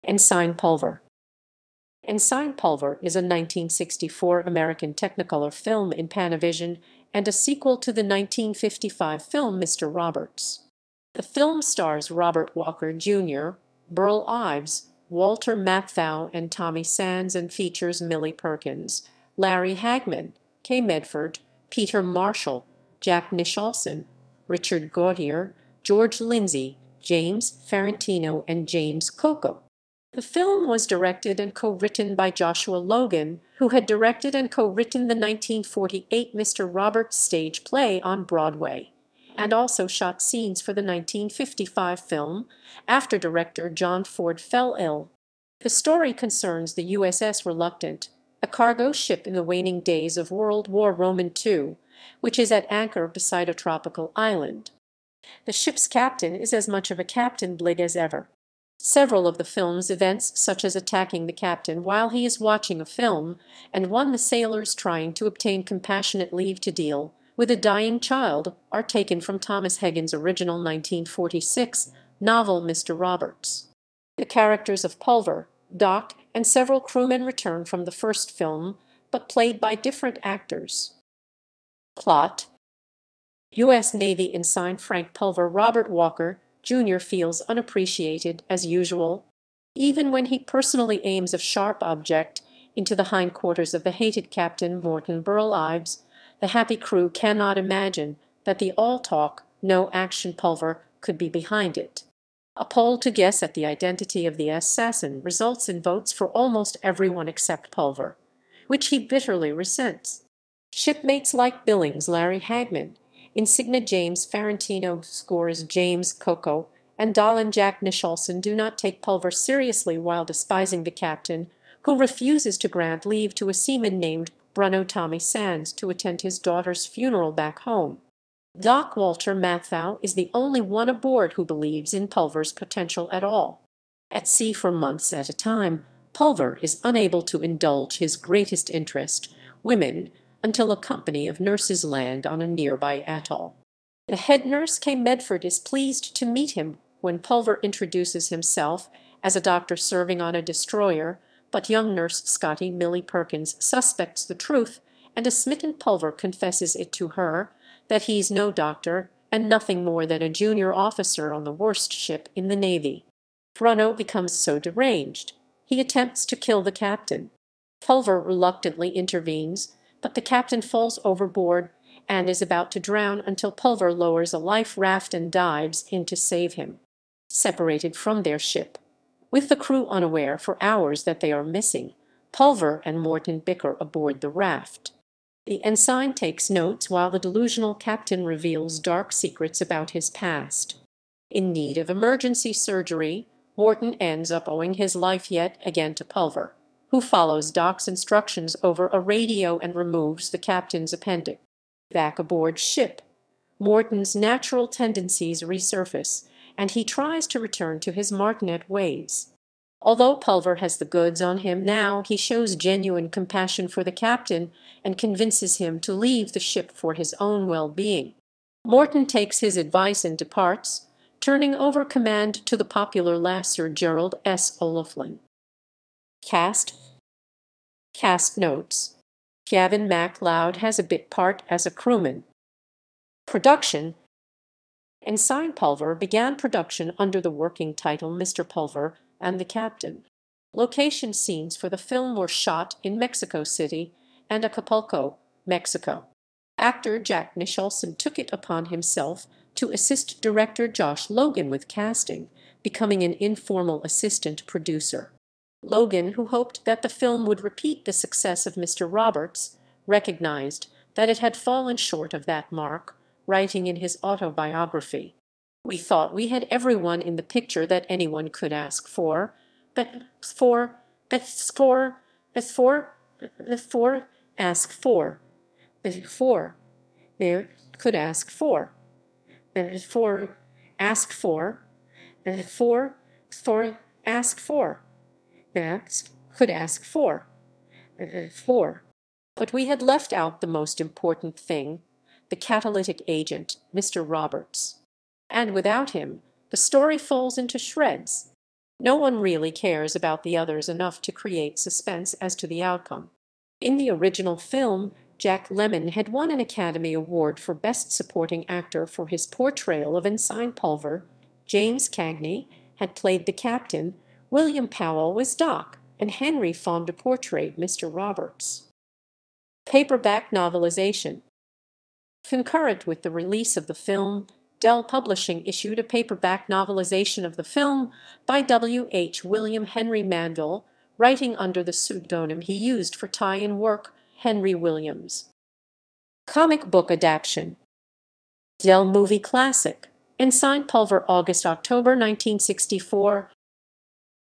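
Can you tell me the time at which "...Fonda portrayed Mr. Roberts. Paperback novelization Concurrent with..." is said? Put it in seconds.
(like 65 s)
316 s.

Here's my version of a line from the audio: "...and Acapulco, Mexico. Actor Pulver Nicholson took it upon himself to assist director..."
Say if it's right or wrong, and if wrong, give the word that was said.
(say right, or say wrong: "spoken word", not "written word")
wrong: "Jack", not "Pulver".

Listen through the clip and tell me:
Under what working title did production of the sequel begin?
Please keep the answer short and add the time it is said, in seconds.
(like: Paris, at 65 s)
Mr. Pulver and the Captain, at 238 s.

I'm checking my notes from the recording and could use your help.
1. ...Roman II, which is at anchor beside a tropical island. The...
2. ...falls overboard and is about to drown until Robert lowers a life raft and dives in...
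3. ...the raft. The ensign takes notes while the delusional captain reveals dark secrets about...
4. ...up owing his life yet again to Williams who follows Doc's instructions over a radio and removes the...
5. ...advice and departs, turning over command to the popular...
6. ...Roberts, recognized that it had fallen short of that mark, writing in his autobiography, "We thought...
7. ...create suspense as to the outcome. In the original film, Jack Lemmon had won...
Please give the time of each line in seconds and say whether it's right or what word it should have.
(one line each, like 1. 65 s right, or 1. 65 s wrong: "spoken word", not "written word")
1. 50 s right
2. 170 s wrong: "Pulver", not "Robert"
3. 184 s right
4. 194 s wrong: "Pulver", not "Williams"
5. 219 s right
6. 258 s right
7. 301 s right.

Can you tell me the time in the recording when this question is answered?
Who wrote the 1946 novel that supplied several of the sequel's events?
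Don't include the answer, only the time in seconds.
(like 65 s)
69 s.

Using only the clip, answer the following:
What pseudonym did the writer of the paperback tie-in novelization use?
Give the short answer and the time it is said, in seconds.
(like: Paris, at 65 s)
Henry Williams, at 334 s.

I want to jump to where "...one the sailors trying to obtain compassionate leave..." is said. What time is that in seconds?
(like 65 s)
63 s.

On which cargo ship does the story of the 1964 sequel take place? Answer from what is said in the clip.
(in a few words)
USS Reluctant.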